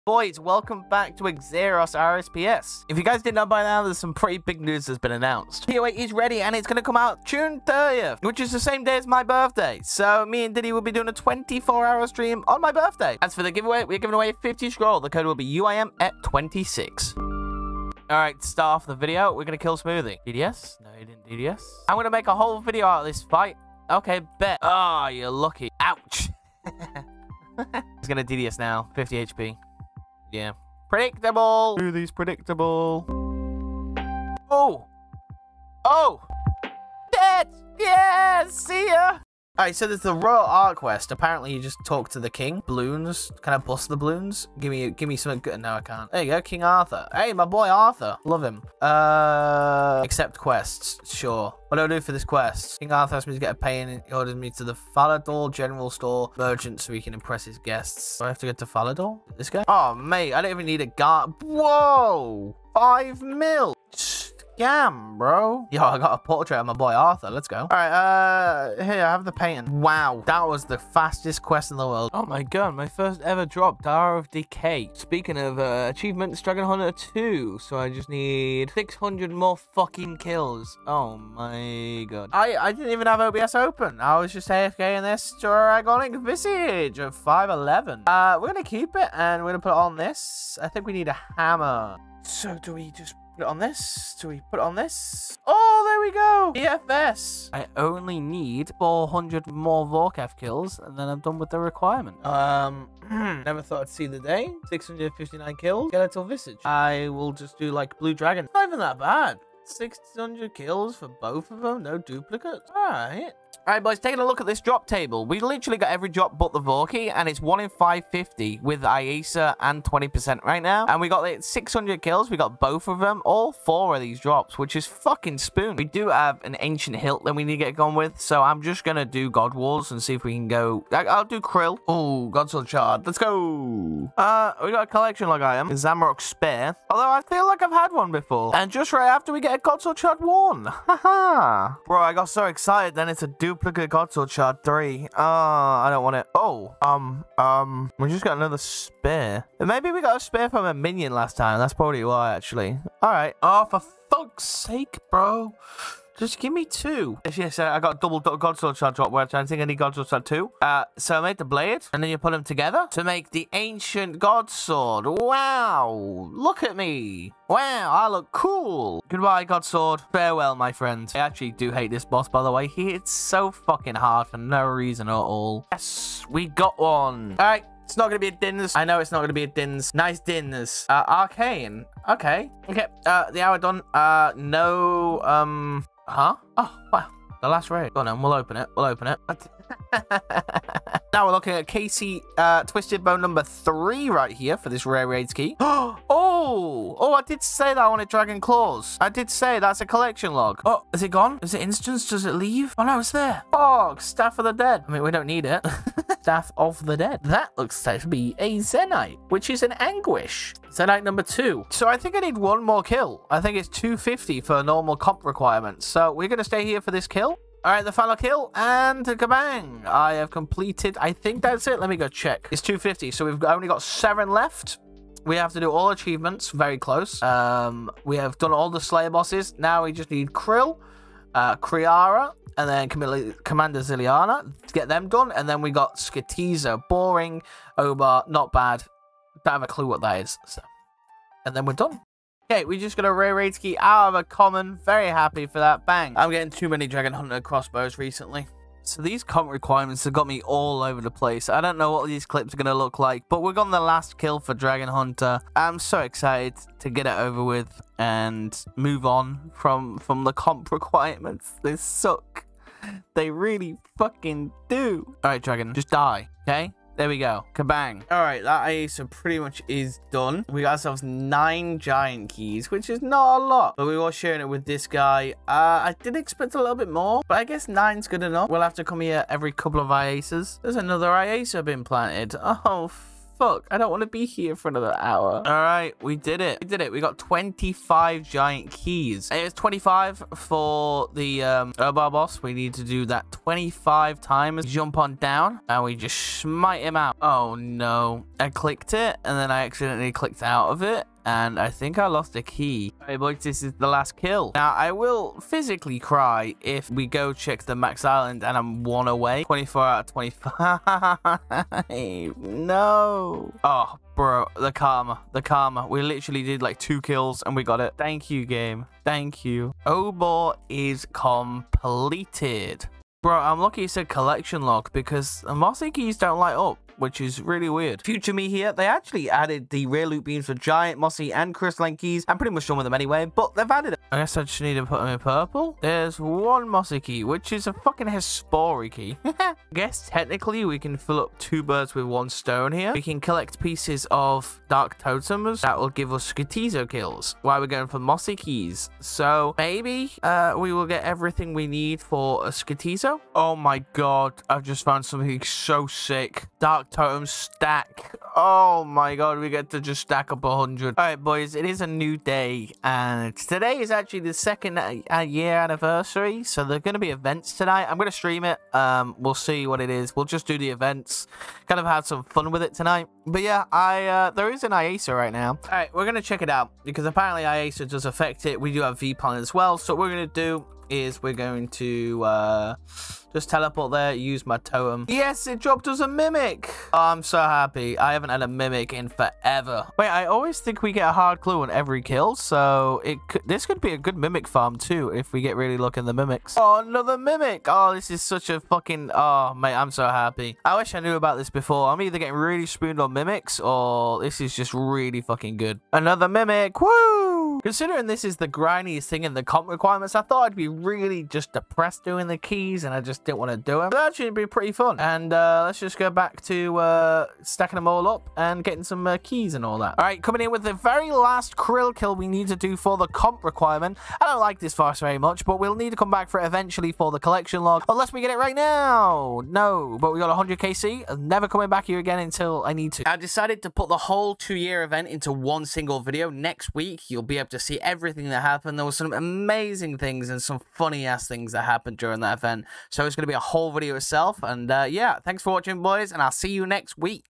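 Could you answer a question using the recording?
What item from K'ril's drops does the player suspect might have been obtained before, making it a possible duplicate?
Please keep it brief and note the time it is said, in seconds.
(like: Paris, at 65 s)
Zamorak Spear, at 135 s.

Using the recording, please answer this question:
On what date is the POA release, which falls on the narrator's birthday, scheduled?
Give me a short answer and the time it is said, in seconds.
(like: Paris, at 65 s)
June 30th, at 7 s.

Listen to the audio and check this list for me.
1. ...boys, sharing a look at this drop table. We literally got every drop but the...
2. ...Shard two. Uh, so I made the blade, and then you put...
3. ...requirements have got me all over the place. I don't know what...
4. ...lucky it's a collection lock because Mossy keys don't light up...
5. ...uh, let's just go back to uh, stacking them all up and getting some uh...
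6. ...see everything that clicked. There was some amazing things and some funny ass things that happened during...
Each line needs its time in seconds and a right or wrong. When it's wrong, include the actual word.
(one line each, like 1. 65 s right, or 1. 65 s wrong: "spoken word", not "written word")
1. 113 s wrong: "taking", not "sharing"
2. 160 s right
3. 249 s right
4. 323 s right
5. 415 s right
6. 437 s wrong: "happened", not "clicked".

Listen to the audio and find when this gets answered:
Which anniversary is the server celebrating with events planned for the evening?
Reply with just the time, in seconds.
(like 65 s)
364 s.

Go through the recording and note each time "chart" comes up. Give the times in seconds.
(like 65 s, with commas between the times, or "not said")
139 s, 144 s.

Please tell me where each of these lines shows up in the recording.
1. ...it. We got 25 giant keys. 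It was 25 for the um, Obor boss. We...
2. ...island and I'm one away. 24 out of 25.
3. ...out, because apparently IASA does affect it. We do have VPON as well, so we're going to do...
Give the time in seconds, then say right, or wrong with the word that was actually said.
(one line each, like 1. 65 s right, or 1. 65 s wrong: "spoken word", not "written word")
1. 286 s right
2. 308 s right
3. 376 s right.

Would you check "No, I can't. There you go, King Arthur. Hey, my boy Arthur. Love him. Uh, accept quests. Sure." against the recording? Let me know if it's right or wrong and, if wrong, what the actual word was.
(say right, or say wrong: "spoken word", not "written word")
right.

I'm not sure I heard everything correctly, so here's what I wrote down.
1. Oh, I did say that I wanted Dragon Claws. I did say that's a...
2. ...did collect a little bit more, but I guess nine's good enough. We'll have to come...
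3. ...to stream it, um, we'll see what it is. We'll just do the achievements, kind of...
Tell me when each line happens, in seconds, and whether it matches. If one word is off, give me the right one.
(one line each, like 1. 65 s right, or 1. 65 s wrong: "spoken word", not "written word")
1. 196 s right
2. 276 s wrong: "expect", not "collect"
3. 368 s wrong: "events", not "achievements".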